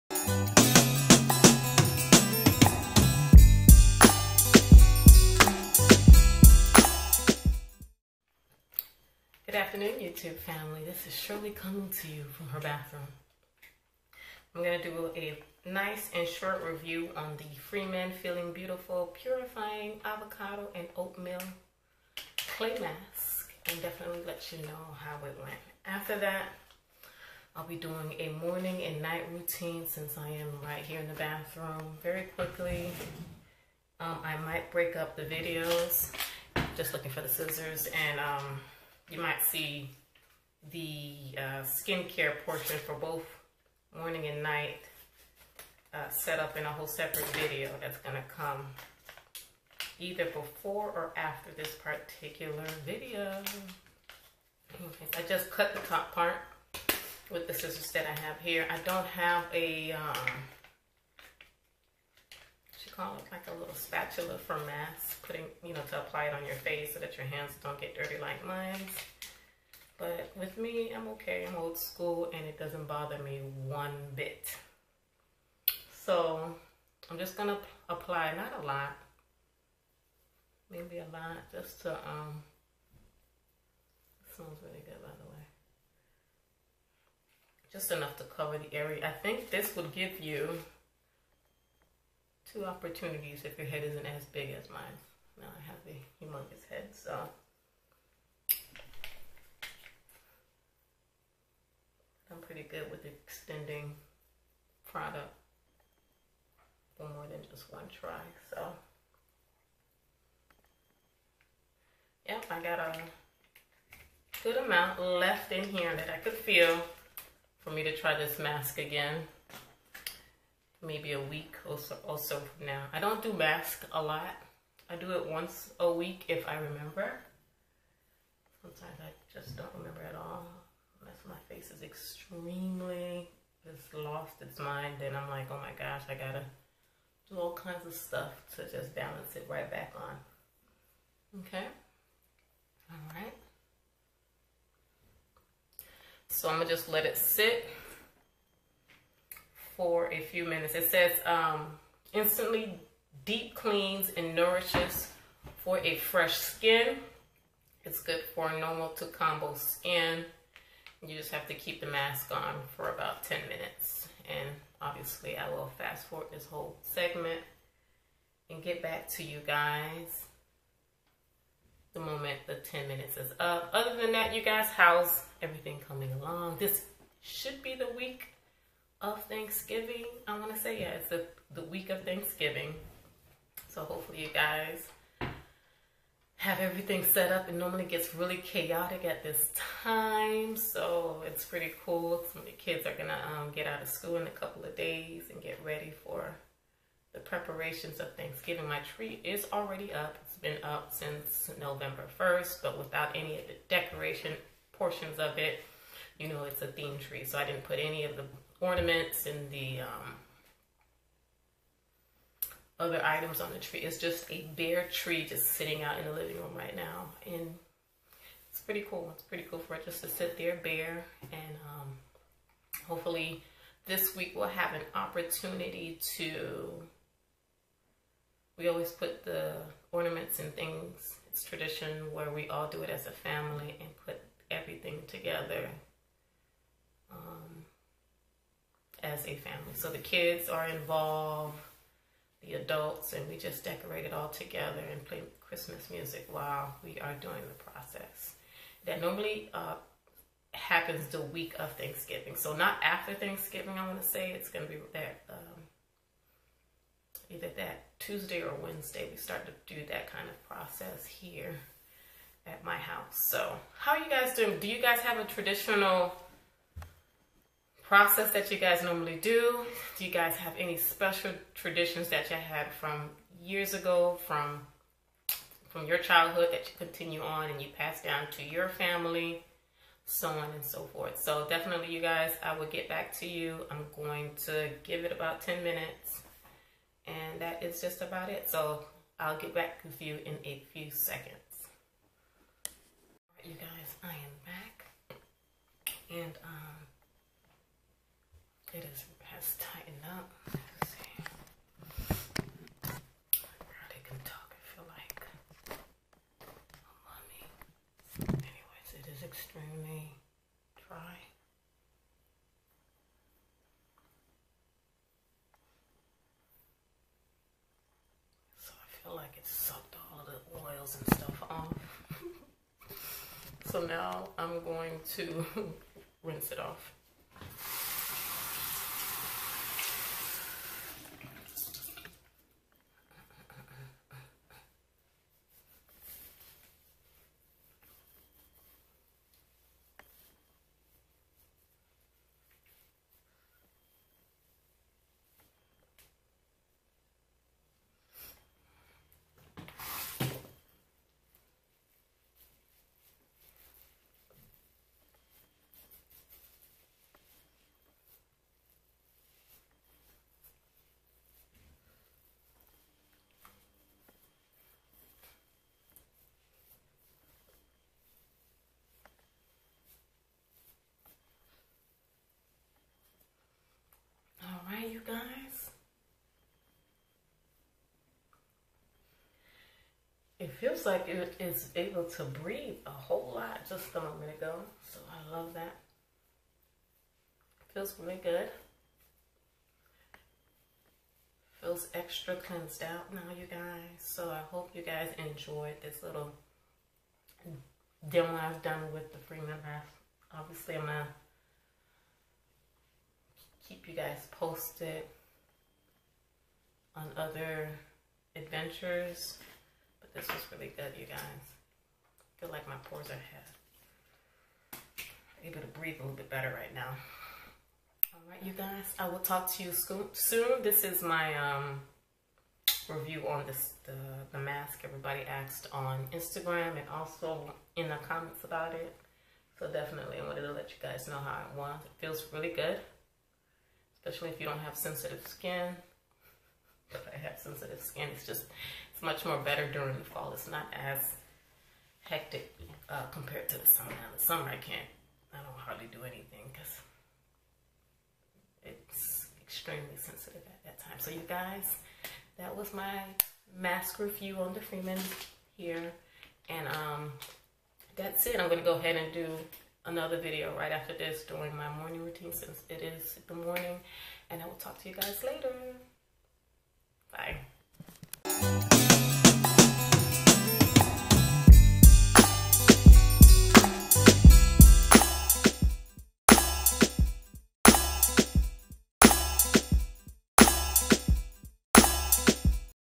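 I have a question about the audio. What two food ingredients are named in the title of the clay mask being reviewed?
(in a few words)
Avocado and Oatmeal.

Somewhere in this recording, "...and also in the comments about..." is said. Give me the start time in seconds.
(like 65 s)
426 s.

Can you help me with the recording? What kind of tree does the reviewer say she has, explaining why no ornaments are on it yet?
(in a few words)
A theme tree.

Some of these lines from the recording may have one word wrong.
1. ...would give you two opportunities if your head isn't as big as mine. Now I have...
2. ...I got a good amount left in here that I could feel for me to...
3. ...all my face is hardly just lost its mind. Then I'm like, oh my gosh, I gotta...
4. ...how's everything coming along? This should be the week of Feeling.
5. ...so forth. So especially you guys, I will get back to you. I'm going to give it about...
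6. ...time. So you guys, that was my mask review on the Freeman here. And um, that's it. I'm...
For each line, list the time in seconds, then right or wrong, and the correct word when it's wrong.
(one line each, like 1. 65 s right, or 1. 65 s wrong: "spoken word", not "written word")
1. 89 s right
2. 112 s right
3. 130 s wrong: "extremely", not "hardly"
4. 174 s wrong: "Thanksgiving", not "Feeling"
5. 280 s wrong: "definitely", not "especially"
6. 450 s right.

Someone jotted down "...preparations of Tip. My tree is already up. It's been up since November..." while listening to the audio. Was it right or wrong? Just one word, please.
wrong.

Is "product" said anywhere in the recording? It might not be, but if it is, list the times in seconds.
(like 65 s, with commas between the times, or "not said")
104 s.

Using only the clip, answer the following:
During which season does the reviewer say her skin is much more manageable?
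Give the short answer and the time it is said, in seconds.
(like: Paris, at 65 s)
Fall, at 439 s.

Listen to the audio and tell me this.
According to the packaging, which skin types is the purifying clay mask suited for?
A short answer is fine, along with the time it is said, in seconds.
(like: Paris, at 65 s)
Normal to combo skin, at 158 s.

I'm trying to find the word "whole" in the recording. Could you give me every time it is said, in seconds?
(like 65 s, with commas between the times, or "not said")
46 s, 166 s, 382 s.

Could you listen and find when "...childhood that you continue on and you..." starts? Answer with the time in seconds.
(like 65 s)
275 s.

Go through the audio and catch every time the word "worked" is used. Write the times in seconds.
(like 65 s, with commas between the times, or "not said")
not said.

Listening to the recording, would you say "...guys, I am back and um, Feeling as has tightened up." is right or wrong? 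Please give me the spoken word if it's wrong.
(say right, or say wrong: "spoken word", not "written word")
wrong: "Good", not "Feeling".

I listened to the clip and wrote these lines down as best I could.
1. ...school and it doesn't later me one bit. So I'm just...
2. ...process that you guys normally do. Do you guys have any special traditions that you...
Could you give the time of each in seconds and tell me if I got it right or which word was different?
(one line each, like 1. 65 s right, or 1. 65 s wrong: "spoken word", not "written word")
1. 71 s wrong: "bother", not "later"
2. 267 s right.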